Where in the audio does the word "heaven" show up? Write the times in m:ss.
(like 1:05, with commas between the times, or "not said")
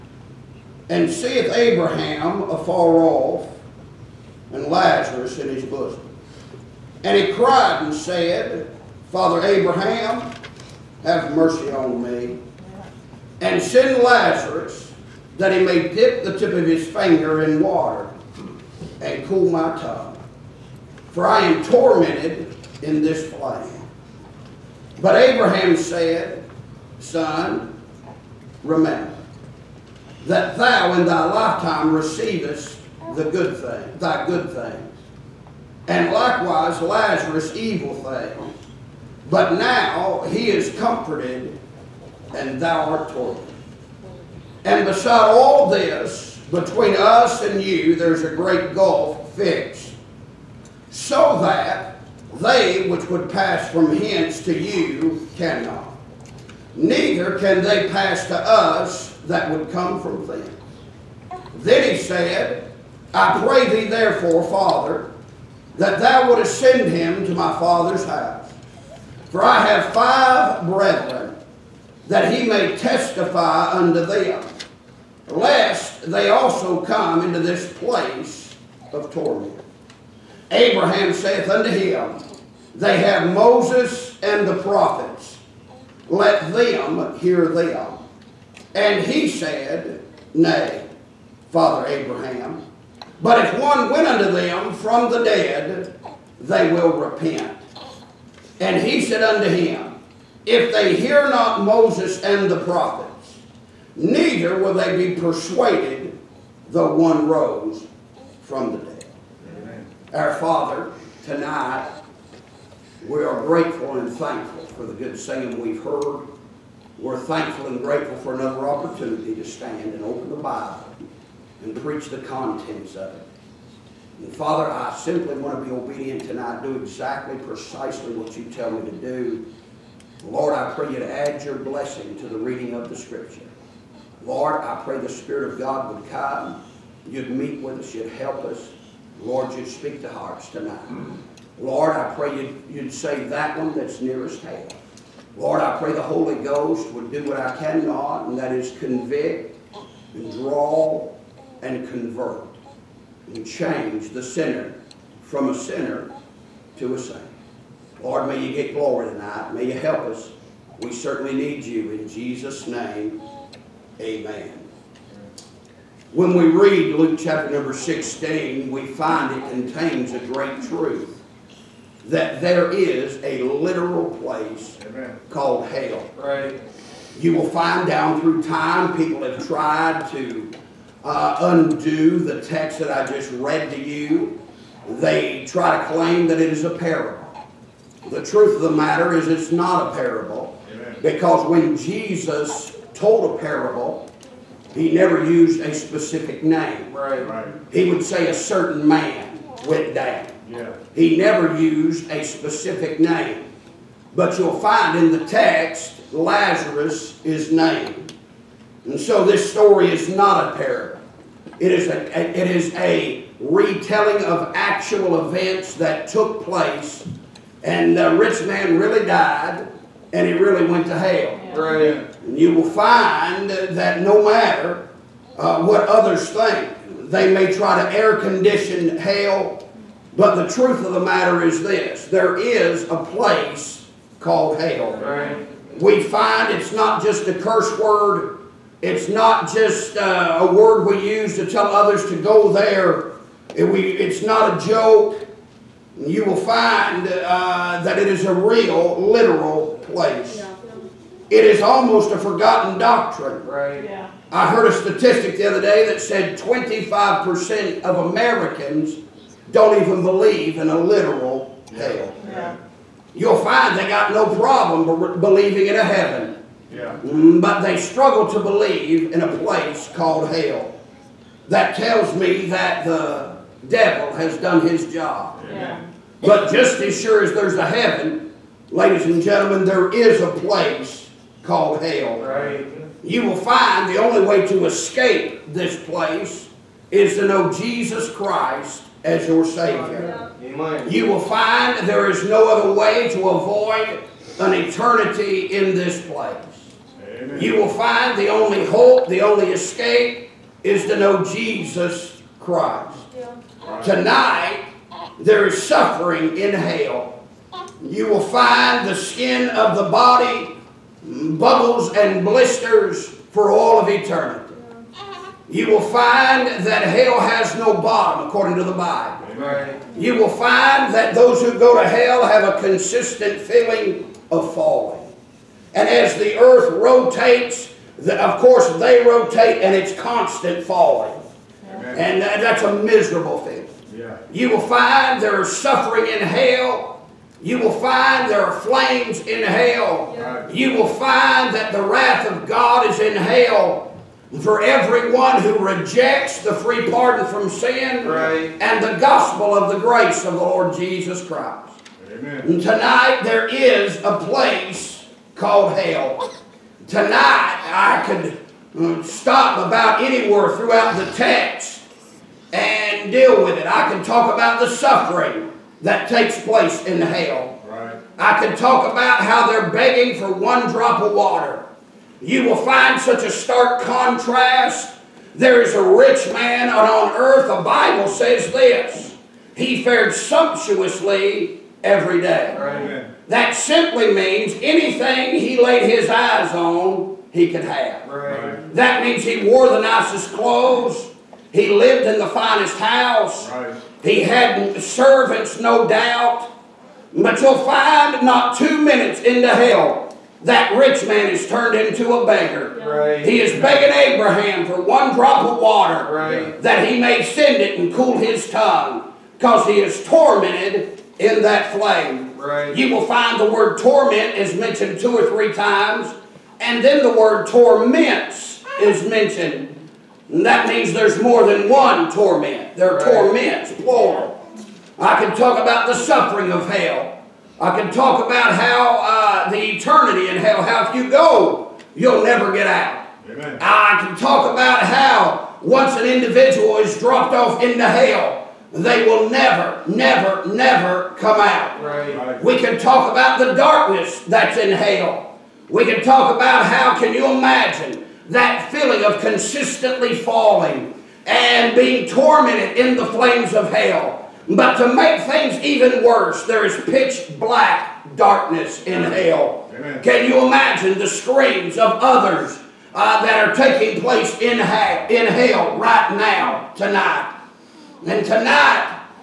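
4:25, 4:37.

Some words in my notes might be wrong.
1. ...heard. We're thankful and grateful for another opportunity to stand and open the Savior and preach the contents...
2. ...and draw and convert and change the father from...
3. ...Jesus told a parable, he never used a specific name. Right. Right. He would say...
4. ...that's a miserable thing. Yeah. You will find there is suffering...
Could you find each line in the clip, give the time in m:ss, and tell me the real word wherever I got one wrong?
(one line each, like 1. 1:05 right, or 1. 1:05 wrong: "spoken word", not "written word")
1. 1:55 wrong: "Bible", not "Savior"
2. 2:30 wrong: "sinner", not "father"
3. 3:11 right
4. 5:32 right.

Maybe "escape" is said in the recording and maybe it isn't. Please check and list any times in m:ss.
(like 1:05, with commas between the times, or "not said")
4:44, 4:59.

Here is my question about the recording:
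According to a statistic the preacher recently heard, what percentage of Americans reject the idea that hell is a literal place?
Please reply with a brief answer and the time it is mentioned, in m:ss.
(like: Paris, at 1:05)
25%, at 4:16.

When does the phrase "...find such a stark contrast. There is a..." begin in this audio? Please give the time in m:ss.
6:12.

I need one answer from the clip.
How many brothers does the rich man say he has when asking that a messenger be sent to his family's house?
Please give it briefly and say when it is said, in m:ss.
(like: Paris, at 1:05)
5, at 1:09.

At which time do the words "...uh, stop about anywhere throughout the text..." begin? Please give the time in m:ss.
5:58.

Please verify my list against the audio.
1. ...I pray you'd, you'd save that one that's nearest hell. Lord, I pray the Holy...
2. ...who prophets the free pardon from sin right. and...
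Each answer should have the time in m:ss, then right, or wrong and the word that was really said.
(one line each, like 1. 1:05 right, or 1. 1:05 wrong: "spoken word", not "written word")
1. 2:21 right
2. 5:45 wrong: "rejects", not "prophets".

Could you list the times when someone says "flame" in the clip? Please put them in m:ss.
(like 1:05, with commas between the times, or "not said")
0:23, 5:38, 6:51, 7:33.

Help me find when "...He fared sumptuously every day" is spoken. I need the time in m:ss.
6:19.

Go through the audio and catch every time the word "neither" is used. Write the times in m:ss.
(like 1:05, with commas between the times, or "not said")
0:56, 1:43.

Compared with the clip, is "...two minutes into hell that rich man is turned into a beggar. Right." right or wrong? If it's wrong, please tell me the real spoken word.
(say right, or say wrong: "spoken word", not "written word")
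right.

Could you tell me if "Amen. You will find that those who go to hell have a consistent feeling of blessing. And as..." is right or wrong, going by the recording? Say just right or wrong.
wrong.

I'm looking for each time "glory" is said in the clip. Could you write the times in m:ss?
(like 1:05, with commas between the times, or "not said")
2:38.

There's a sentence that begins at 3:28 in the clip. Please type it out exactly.
And so this story is not a parable.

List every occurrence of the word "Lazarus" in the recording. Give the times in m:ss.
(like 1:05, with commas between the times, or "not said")
0:04, 0:14, 0:36, 3:26.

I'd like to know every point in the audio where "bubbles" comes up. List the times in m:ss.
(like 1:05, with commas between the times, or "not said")
5:11.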